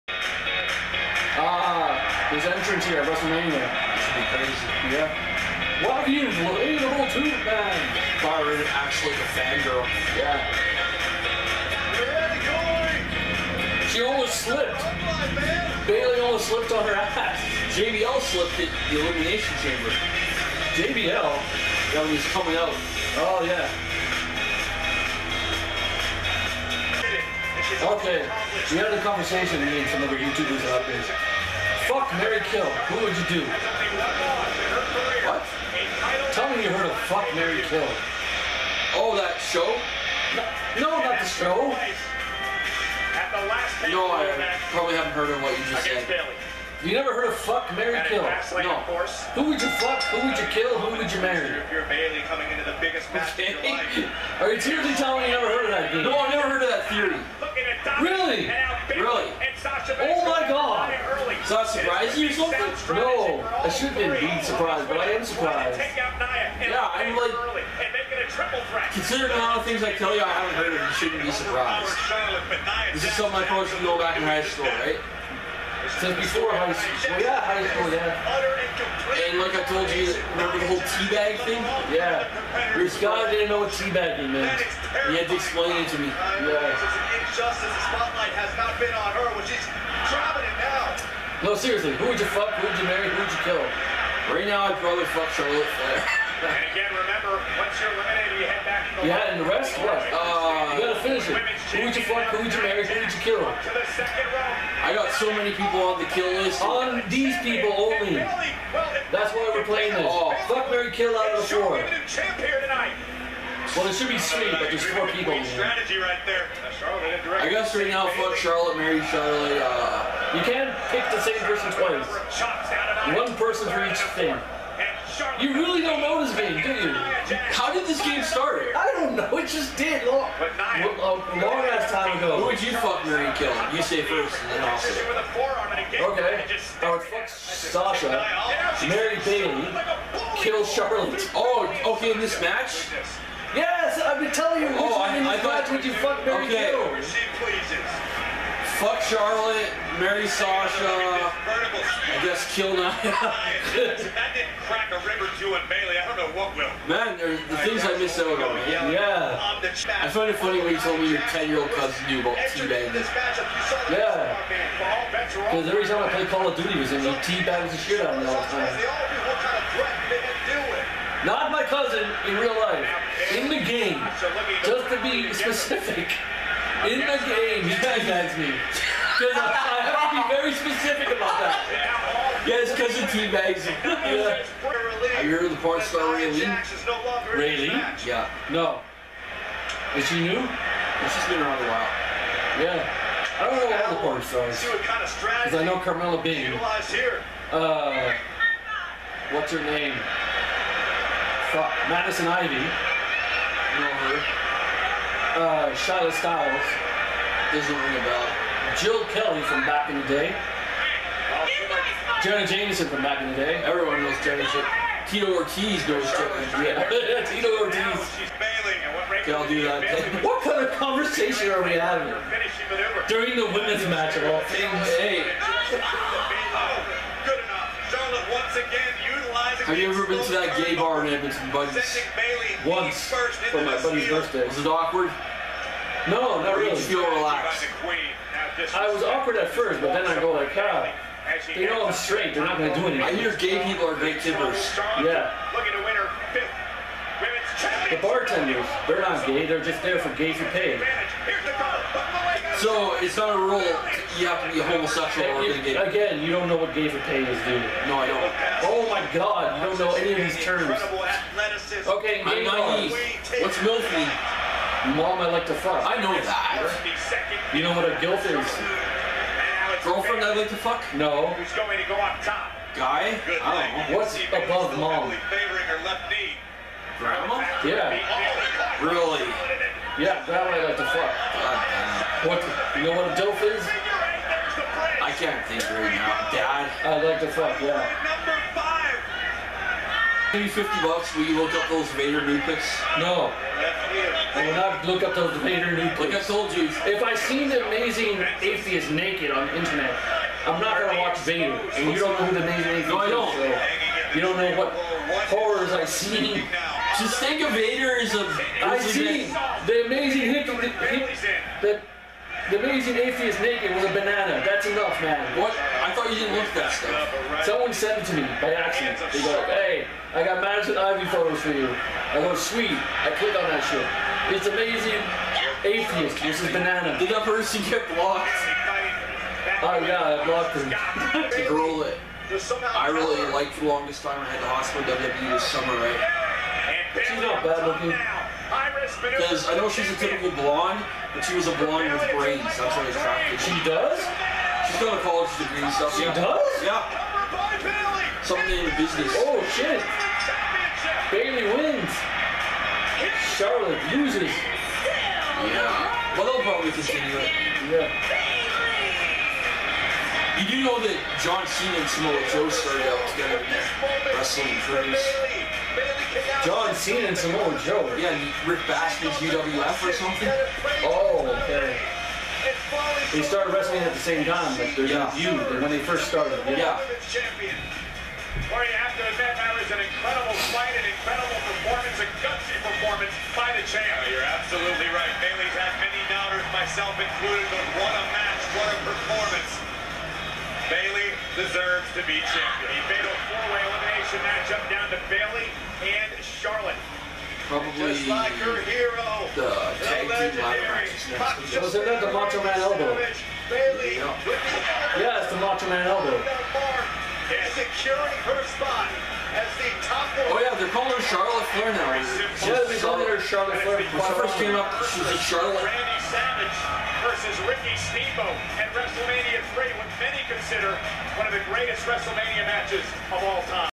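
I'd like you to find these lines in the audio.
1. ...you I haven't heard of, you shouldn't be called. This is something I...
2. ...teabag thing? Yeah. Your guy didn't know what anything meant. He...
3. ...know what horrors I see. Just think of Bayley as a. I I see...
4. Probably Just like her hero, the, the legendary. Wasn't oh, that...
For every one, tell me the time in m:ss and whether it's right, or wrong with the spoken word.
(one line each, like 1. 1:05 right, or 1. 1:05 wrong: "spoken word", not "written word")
1. 1:10 wrong: "surprised", not "called"
2. 1:20 wrong: "teabagging", not "anything"
3. 5:04 wrong: "Vader", not "Bayley"
4. 6:37 right.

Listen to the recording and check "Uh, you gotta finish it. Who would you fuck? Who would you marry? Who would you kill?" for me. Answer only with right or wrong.
right.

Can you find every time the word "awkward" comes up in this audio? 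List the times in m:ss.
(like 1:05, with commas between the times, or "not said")
3:54, 3:59.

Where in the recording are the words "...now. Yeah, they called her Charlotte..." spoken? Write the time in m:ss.
6:51.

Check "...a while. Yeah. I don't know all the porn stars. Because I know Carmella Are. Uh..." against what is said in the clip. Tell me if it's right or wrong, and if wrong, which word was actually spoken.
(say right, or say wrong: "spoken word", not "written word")
wrong: "Bing", not "Are".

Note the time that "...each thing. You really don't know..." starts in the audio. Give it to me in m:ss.
2:03.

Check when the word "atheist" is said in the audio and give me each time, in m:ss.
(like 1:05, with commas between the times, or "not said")
4:58, 5:02, 5:12, 5:25.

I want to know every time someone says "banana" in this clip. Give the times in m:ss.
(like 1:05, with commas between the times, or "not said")
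5:13, 5:26.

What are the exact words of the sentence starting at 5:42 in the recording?
That's what I was attracted She does?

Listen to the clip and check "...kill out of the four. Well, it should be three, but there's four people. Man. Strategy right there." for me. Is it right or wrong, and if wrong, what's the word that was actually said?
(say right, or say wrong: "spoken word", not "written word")
right.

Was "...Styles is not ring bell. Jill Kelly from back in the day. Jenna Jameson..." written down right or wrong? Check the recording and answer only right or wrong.
right.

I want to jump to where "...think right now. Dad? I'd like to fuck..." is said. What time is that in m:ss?
4:45.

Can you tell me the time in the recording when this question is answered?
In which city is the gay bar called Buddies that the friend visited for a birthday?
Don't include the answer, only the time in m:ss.
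3:51.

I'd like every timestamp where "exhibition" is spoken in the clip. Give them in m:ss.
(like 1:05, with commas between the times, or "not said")
6:34.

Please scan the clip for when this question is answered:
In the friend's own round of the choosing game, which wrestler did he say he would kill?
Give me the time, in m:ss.
2:32.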